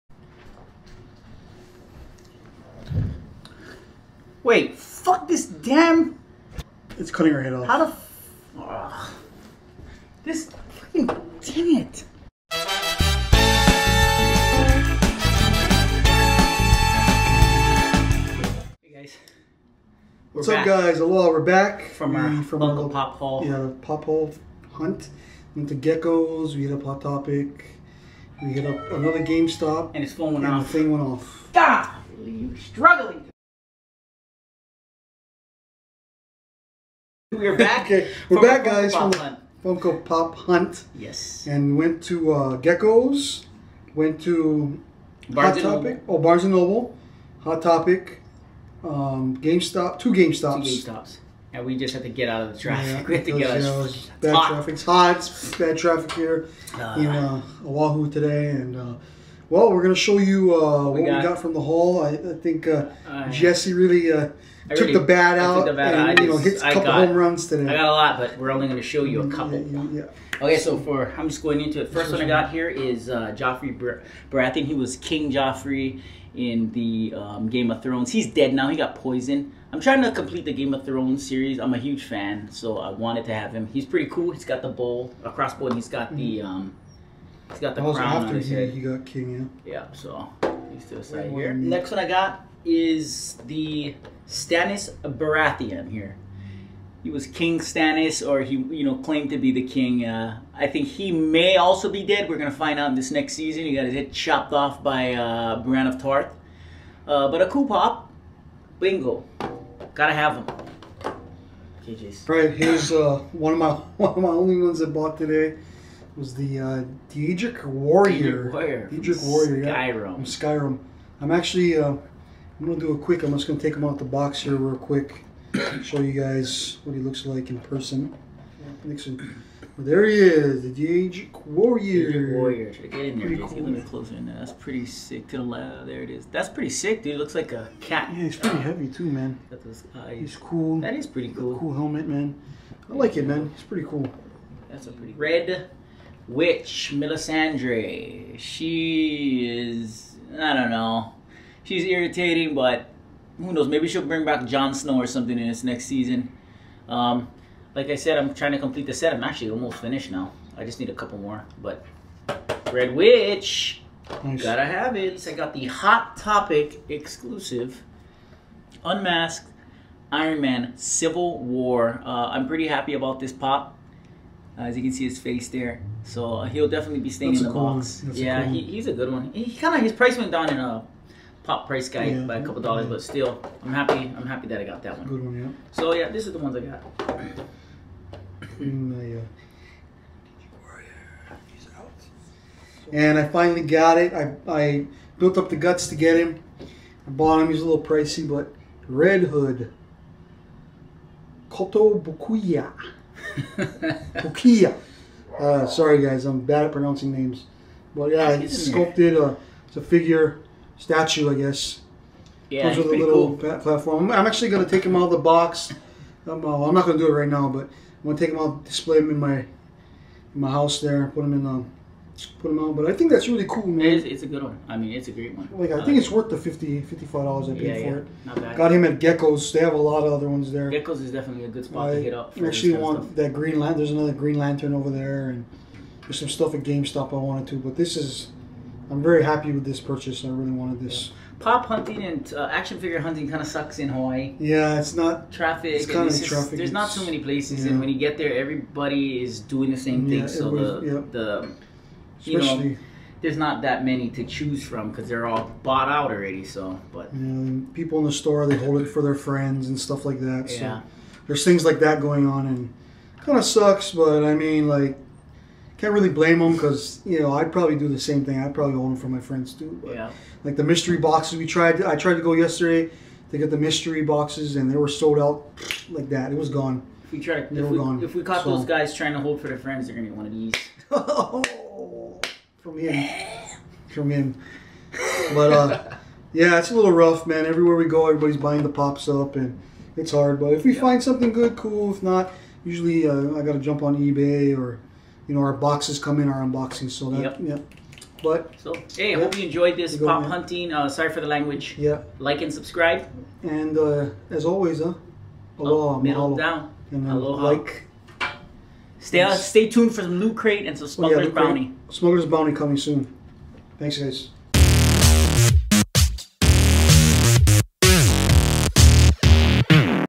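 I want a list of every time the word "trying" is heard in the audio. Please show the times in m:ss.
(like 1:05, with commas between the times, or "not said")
1:19, 2:38, 4:38.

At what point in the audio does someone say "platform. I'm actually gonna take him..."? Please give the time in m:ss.
3:33.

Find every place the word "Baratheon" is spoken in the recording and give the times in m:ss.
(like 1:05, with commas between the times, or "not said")
1:14, 1:35.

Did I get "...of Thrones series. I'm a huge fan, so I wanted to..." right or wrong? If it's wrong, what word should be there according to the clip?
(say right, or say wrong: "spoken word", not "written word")
right.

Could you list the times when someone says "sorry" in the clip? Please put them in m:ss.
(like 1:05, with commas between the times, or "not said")
3:25, 5:00.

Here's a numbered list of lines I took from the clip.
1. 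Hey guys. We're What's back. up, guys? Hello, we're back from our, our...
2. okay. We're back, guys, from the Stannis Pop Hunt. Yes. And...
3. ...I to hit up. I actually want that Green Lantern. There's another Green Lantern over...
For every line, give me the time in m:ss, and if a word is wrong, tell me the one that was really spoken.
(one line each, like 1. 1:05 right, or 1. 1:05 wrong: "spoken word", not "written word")
1. 0:18 right
2. 0:37 wrong: "Funko", not "Stannis"
3. 3:51 right.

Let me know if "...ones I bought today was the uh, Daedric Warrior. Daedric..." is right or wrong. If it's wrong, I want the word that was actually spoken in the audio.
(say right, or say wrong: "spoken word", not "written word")
right.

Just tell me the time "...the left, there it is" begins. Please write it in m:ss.
2:15.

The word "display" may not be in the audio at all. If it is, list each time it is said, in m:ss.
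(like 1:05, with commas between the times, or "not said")
3:38.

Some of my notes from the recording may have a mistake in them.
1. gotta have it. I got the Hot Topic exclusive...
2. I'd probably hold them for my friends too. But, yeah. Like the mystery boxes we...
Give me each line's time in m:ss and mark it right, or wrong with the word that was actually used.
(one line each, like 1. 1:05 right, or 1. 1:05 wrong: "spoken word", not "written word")
1. 2:44 right
2. 4:28 right.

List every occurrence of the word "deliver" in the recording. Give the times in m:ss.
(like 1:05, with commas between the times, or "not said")
not said.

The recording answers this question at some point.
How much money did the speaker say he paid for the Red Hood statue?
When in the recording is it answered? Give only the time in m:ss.
3:46.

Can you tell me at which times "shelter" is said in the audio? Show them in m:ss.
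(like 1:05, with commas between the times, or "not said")
not said.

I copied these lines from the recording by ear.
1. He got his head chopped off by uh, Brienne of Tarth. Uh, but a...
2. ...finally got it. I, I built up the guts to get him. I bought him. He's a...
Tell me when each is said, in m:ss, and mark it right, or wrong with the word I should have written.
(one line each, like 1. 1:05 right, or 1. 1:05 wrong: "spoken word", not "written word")
1. 1:43 right
2. 3:13 right.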